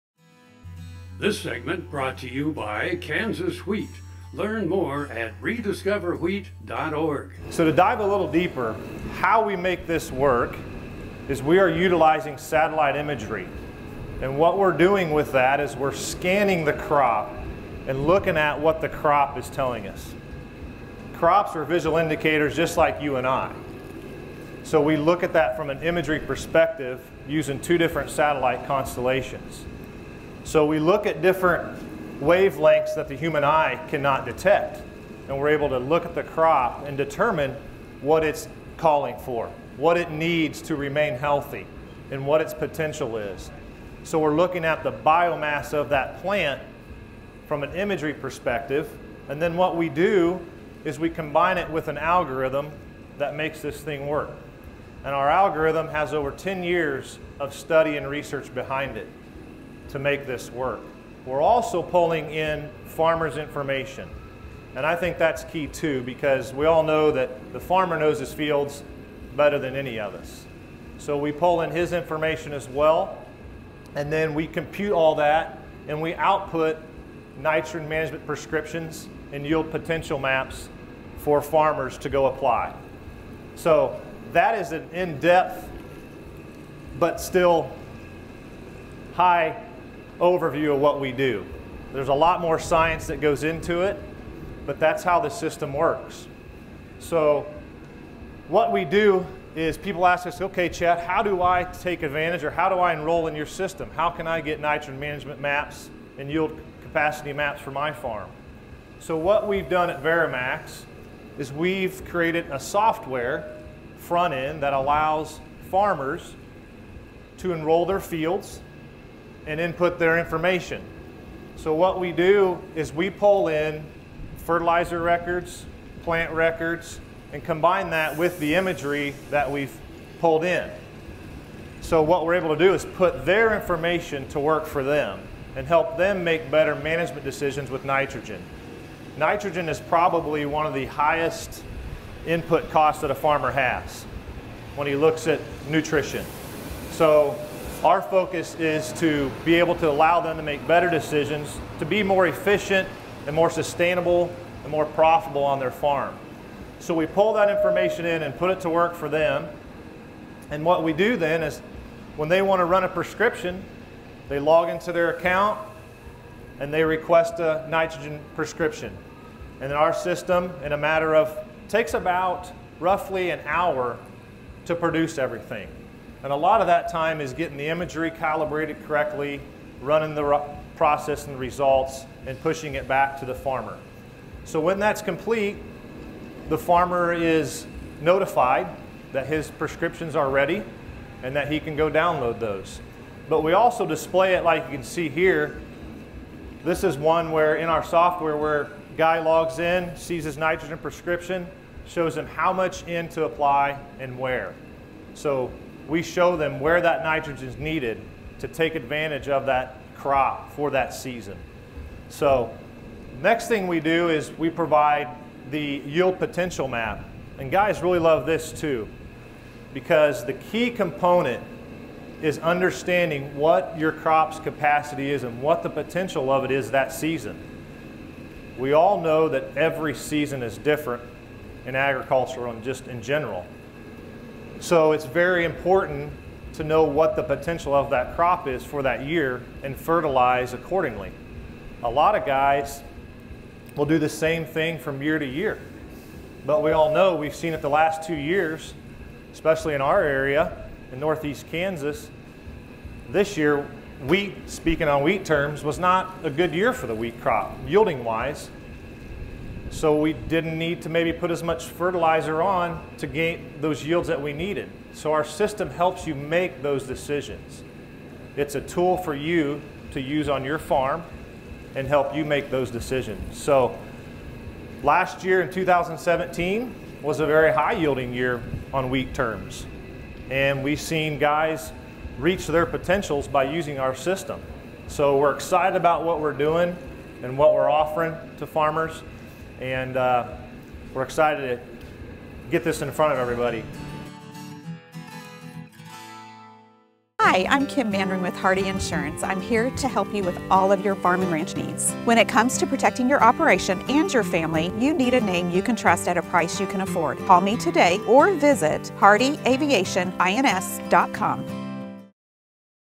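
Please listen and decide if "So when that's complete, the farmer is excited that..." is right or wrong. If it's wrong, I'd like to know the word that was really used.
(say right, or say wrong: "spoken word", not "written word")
wrong: "notified", not "excited".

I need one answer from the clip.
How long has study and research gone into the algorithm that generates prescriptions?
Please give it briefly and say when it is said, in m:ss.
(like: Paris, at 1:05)
Over 10 years, at 0:56.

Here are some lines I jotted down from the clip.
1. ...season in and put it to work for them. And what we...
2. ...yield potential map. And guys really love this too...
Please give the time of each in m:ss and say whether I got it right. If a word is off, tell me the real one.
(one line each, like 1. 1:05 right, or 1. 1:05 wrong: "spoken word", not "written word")
1. 2:37 wrong: "information", not "season"
2. 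3:35 right.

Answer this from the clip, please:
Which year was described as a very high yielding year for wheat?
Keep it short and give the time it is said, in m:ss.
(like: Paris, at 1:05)
2017, at 4:35.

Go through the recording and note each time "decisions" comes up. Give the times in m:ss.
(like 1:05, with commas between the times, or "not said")
2:17, 2:30, 4:26, 4:32.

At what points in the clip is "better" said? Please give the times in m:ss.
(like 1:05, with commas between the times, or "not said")
1:09, 2:16, 2:30.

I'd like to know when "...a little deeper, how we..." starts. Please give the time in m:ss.
0:07.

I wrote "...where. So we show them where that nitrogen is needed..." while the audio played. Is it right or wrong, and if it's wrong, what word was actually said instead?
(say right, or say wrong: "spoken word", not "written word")
right.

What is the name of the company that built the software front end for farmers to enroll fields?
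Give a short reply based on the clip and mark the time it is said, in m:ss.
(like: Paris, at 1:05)
VariMax, at 1:50.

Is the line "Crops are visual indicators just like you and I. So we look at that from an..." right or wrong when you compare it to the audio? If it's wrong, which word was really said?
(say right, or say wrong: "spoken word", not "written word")
right.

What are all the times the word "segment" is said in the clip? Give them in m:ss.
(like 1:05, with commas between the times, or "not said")
0:01.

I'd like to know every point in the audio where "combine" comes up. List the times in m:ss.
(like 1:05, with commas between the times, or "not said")
0:51, 2:07.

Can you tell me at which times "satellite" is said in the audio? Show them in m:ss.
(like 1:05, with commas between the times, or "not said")
0:12, 0:28.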